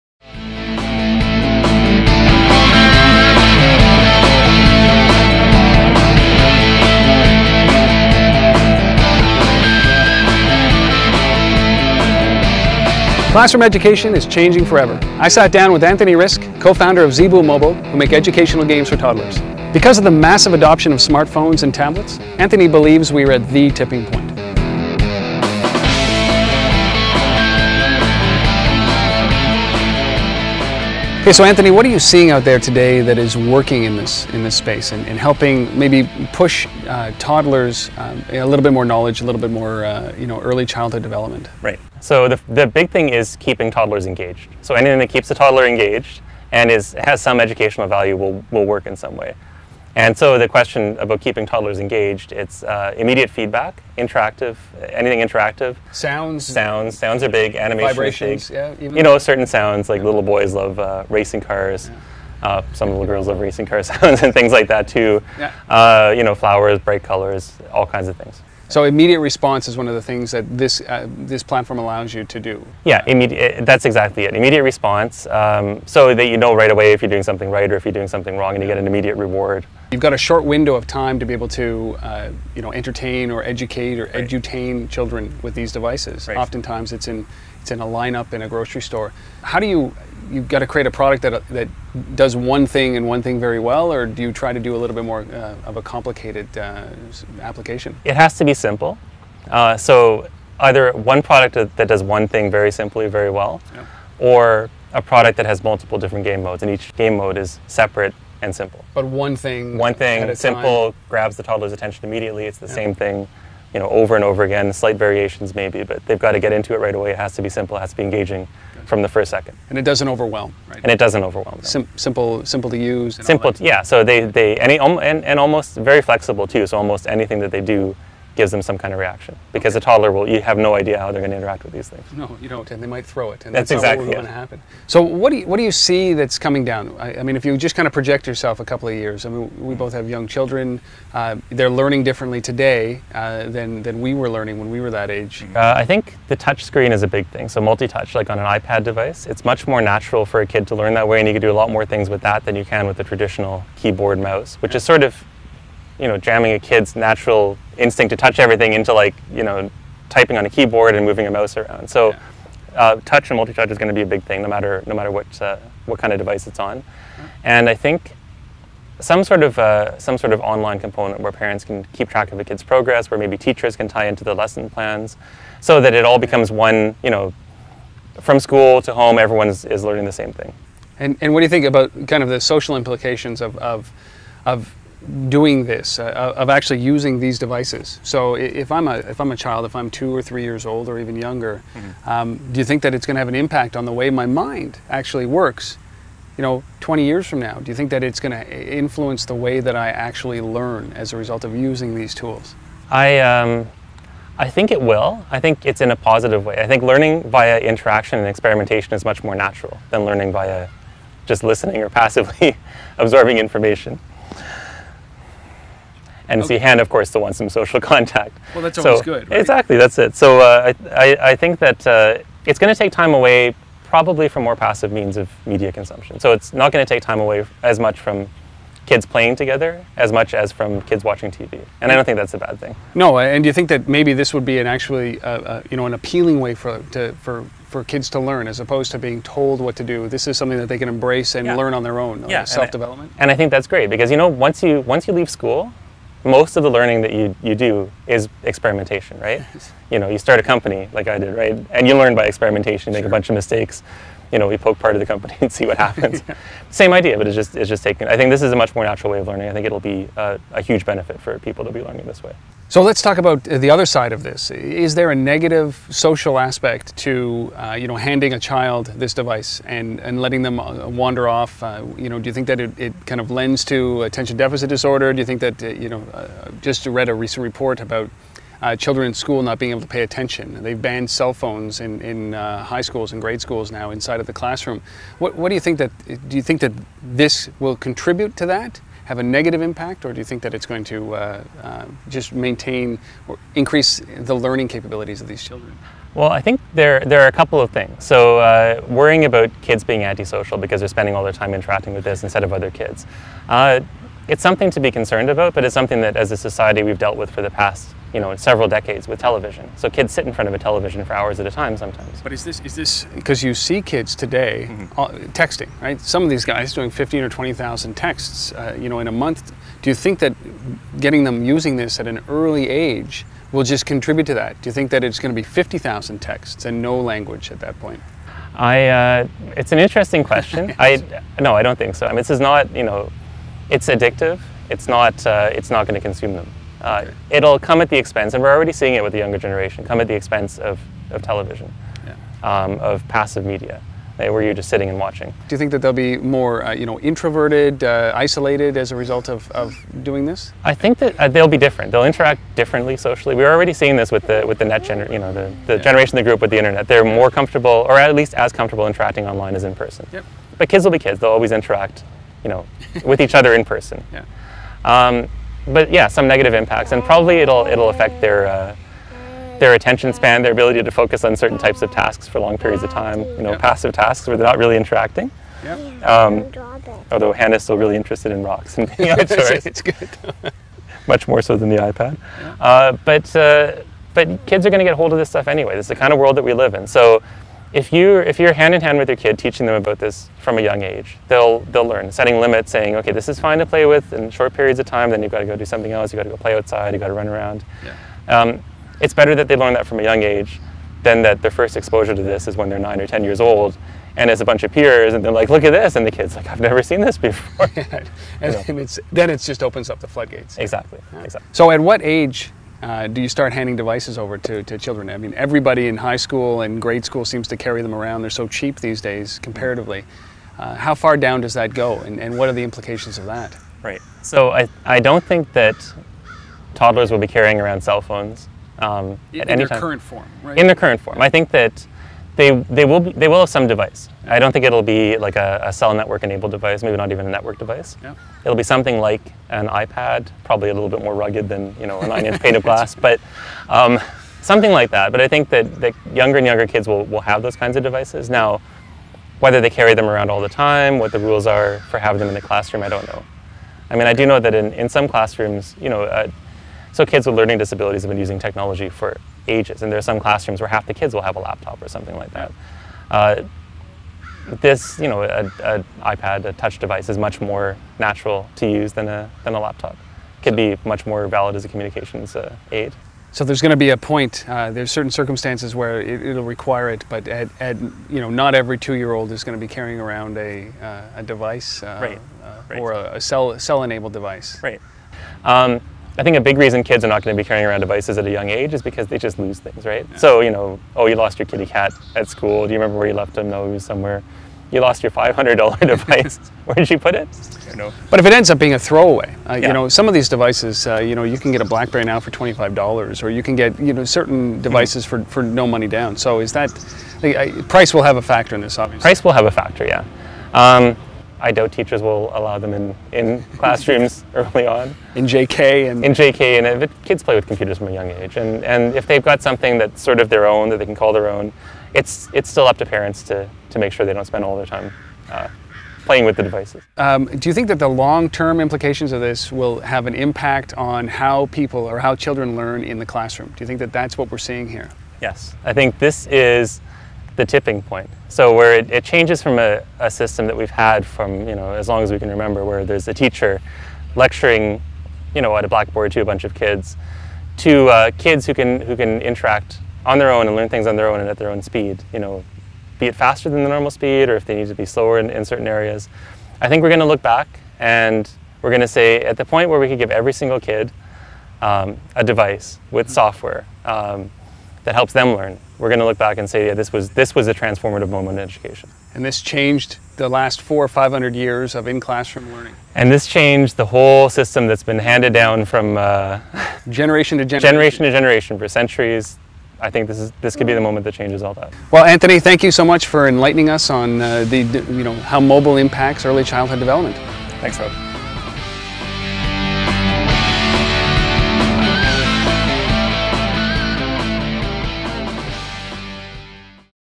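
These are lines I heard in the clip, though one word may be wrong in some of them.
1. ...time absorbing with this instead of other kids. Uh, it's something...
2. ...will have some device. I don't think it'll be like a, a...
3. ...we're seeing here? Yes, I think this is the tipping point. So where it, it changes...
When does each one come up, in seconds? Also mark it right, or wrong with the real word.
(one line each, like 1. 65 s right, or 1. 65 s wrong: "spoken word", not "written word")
1. 301 s wrong: "interacting", not "absorbing"
2. 433 s right
3. 534 s right.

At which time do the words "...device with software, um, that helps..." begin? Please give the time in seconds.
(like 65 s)
562 s.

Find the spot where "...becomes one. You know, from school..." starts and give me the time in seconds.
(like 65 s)
176 s.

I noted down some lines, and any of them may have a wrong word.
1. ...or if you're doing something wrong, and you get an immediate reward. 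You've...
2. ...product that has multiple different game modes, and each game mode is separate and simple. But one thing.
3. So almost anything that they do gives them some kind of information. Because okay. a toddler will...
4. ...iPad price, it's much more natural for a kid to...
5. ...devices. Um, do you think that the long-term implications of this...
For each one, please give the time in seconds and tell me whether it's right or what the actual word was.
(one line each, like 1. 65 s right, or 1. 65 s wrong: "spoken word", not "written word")
1. 77 s right
2. 105 s right
3. 126 s wrong: "reaction", not "information"
4. 148 s wrong: "device", not "price"
5. 526 s right.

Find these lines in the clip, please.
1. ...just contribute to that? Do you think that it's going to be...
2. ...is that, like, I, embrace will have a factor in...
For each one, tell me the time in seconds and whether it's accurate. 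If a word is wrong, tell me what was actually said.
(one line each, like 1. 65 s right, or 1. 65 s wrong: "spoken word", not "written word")
1. 323 s right
2. 506 s wrong: "price", not "embrace".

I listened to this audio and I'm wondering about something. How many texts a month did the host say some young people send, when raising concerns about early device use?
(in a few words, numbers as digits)
15 or 20,000.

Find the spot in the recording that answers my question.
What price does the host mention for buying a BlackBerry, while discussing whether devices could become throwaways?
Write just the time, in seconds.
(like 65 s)
502 s.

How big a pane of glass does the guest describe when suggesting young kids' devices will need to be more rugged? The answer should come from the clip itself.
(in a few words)
nine inch.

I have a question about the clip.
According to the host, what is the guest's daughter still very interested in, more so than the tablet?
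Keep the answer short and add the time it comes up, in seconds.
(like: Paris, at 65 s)
rocks, at 378 s.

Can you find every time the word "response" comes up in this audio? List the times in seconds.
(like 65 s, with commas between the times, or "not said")
69 s, 74 s.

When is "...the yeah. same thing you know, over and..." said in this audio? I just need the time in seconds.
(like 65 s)
112 s.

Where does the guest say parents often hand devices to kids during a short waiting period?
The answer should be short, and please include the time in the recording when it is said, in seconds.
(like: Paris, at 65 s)
grocery store, at 88 s.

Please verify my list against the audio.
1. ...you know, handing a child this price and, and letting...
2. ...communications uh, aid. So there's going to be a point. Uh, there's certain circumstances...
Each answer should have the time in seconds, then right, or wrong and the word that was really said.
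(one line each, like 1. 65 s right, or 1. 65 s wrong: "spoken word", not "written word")
1. 267 s wrong: "device", not "price"
2. 471 s right.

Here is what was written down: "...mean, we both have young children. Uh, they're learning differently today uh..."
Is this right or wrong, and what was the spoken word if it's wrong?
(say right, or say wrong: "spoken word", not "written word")
right.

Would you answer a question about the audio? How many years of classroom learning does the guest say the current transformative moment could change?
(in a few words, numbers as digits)
400 or 500.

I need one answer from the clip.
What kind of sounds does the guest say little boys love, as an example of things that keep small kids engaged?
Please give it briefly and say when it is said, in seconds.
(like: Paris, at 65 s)
racing cars, at 61 s.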